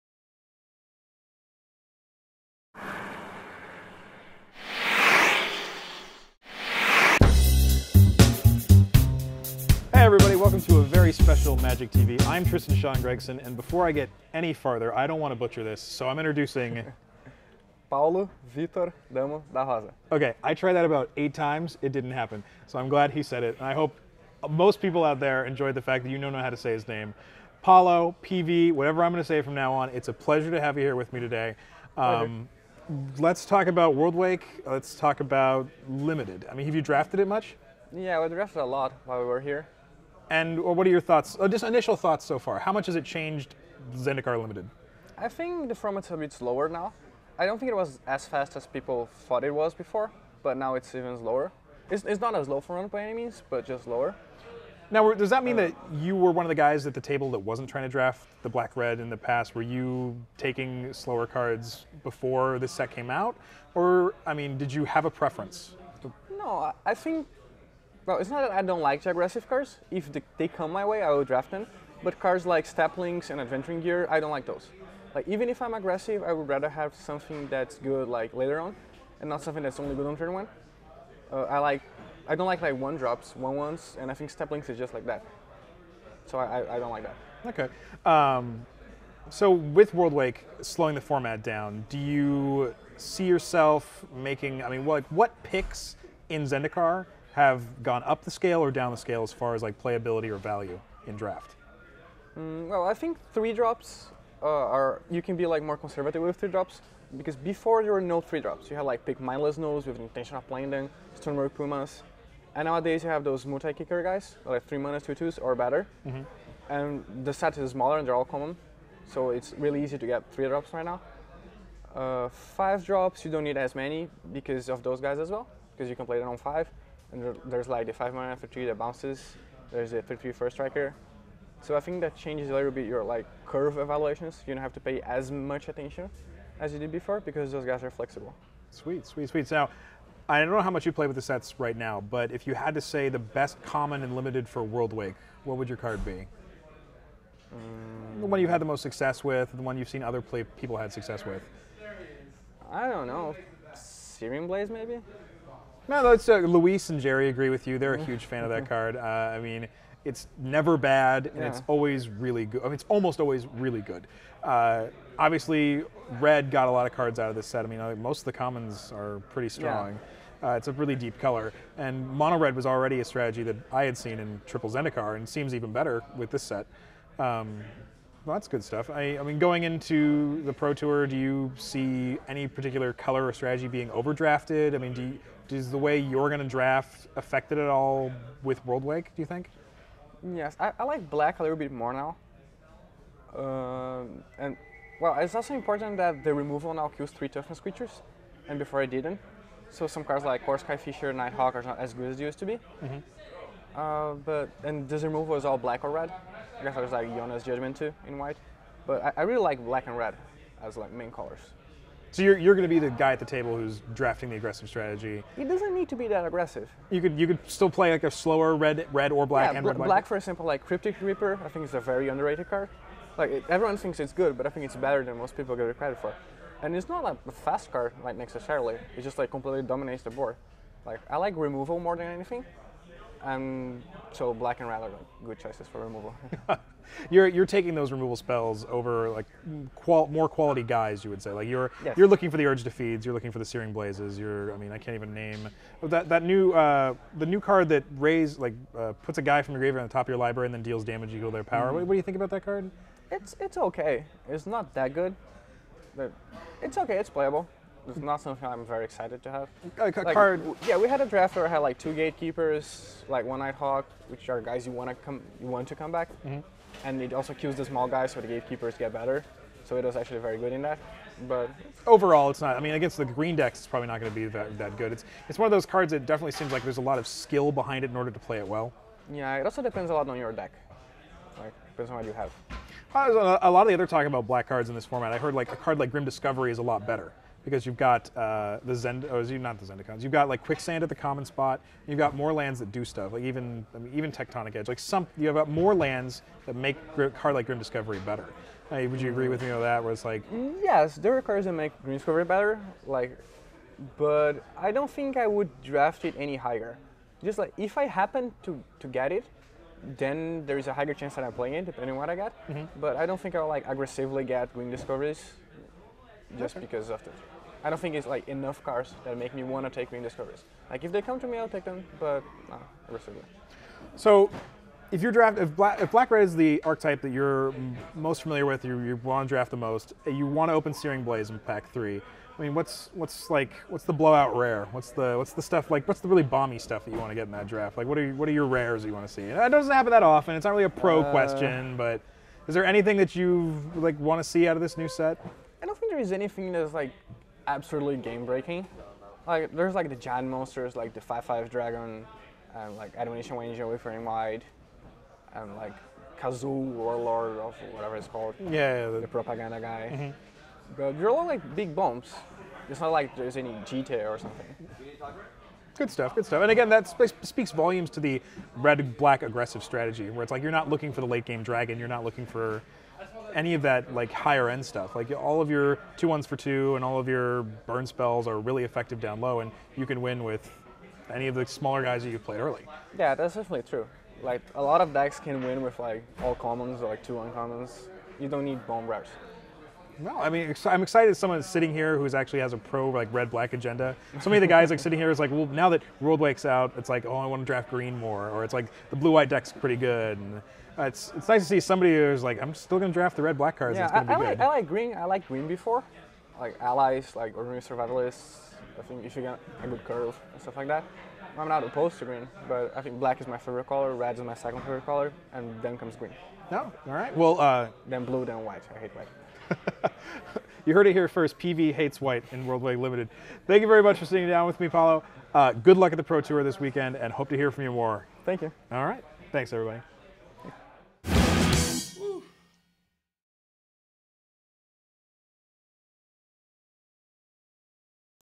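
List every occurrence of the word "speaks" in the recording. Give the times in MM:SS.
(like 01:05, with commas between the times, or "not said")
06:07.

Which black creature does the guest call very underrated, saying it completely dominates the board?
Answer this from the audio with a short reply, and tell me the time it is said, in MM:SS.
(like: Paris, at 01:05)
Crypt Ripper, at 03:40.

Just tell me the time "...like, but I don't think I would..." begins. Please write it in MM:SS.
05:02.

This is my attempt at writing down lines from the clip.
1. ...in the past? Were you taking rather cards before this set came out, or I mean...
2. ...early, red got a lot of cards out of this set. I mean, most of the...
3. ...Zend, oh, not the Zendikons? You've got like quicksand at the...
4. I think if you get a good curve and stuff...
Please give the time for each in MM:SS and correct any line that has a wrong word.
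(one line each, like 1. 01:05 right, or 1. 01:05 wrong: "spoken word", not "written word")
1. 00:59 wrong: "slower", not "rather"
2. 02:45 wrong: "obviously", not "early"
3. 04:48 right
4. 06:48 right.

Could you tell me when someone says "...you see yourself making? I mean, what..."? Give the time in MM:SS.
01:31.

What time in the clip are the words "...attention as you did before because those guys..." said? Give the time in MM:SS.
02:15.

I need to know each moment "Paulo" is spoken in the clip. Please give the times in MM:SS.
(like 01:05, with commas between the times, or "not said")
00:17, 00:27, 07:04.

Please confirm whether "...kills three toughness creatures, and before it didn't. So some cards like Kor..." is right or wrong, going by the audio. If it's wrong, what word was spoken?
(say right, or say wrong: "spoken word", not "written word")
right.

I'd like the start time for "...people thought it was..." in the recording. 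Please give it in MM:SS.
00:48.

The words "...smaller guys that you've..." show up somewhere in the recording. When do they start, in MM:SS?
06:21.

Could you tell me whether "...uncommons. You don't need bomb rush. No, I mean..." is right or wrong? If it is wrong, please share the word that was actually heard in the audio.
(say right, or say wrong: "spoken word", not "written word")
right.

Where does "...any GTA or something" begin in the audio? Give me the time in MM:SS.
06:03.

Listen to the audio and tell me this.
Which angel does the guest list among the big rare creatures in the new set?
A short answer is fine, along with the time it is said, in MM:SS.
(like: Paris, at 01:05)
Admonition Angel, at 05:52.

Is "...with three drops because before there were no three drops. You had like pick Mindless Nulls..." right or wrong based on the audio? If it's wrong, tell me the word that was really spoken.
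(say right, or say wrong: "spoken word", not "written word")
right.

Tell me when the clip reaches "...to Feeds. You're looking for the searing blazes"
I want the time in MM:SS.
04:02.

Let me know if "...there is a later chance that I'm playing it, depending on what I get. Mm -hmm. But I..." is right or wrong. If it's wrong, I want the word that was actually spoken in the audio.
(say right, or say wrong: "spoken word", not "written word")
wrong: "higher", not "later".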